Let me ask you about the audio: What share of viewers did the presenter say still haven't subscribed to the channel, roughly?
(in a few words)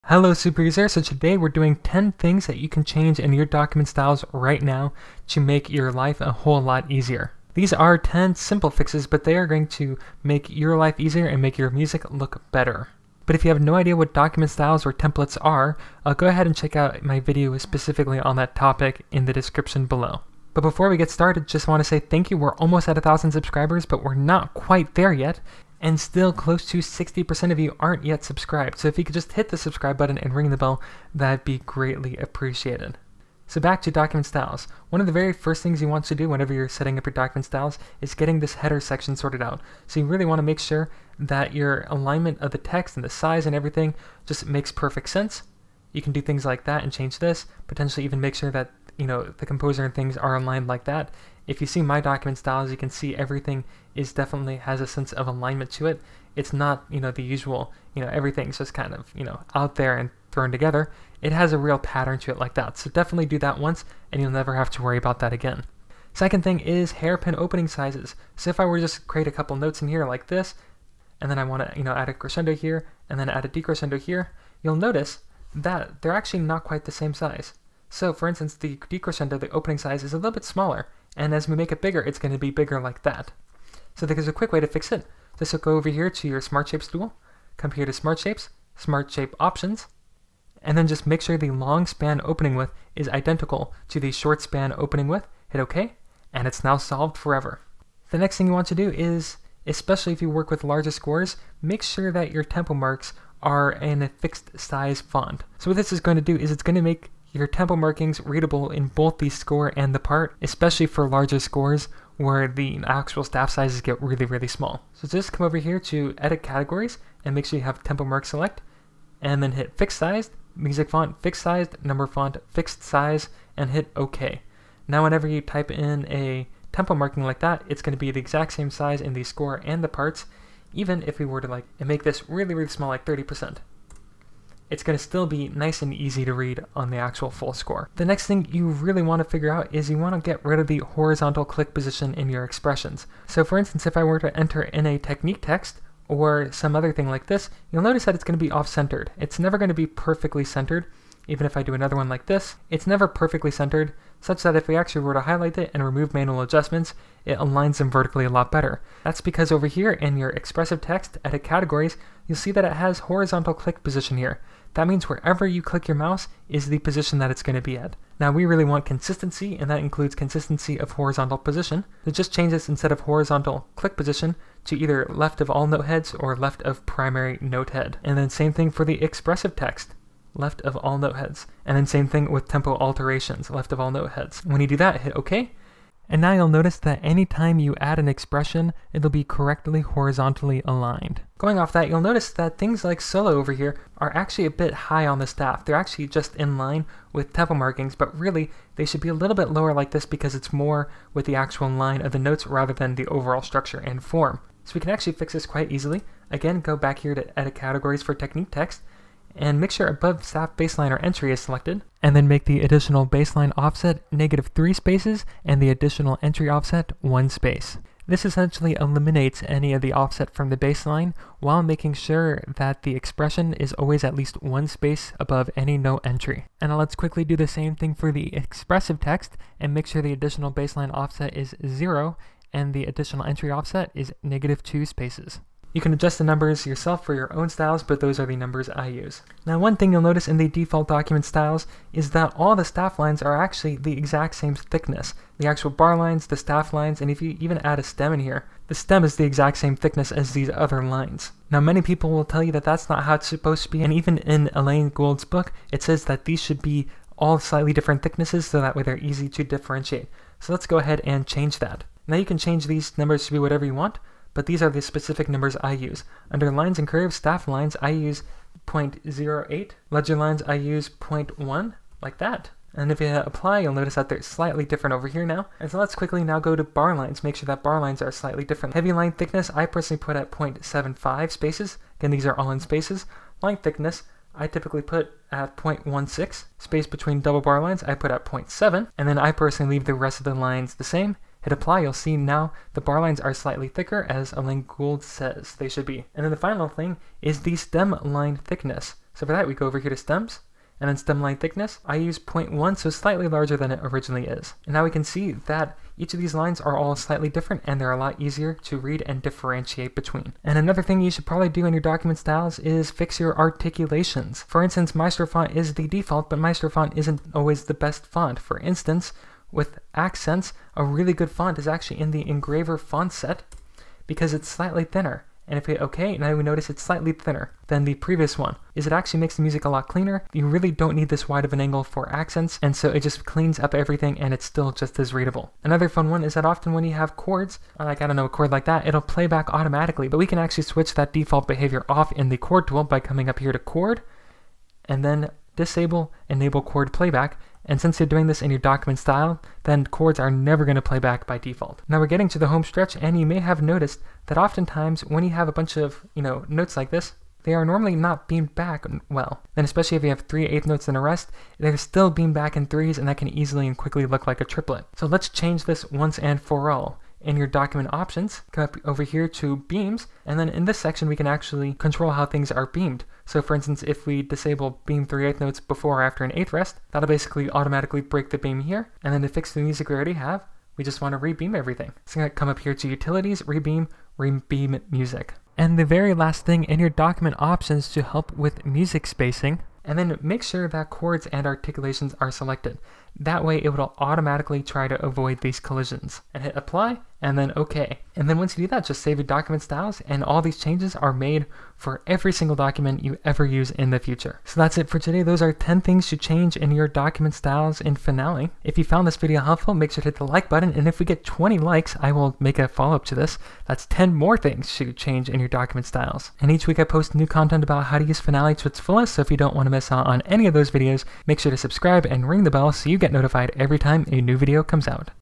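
60%.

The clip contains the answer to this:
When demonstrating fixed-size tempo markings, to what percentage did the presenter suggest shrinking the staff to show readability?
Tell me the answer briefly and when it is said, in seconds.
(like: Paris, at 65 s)
30%, at 133 s.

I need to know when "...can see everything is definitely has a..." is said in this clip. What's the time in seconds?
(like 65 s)
52 s.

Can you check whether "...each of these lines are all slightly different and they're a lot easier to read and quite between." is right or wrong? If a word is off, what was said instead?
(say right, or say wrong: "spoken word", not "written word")
wrong: "differentiate", not "quite".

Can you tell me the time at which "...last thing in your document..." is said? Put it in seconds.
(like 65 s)
386 s.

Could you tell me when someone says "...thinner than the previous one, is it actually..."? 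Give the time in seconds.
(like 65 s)
327 s.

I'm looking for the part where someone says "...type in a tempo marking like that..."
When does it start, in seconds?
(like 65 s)
125 s.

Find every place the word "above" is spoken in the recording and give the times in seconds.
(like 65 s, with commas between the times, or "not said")
209 s, 225 s.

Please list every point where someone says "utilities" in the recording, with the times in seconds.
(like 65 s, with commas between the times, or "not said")
382 s.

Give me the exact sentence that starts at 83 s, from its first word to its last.
So there's a quick way to fix it.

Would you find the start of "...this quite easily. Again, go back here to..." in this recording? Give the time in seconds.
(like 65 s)
205 s.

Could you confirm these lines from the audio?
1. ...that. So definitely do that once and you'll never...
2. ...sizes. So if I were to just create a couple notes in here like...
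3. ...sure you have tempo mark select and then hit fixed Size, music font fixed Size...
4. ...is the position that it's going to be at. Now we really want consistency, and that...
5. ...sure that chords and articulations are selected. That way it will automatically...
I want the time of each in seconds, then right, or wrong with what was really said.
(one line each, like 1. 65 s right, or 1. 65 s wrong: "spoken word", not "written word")
1. 62 s right
2. 67 s right
3. 117 s right
4. 166 s right
5. 390 s right.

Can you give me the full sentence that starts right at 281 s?
Again, these are all in spaces.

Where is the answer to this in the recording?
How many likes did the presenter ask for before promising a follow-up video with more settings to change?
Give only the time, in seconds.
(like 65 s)
411 s.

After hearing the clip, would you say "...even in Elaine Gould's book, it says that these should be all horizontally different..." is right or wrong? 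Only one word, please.
wrong.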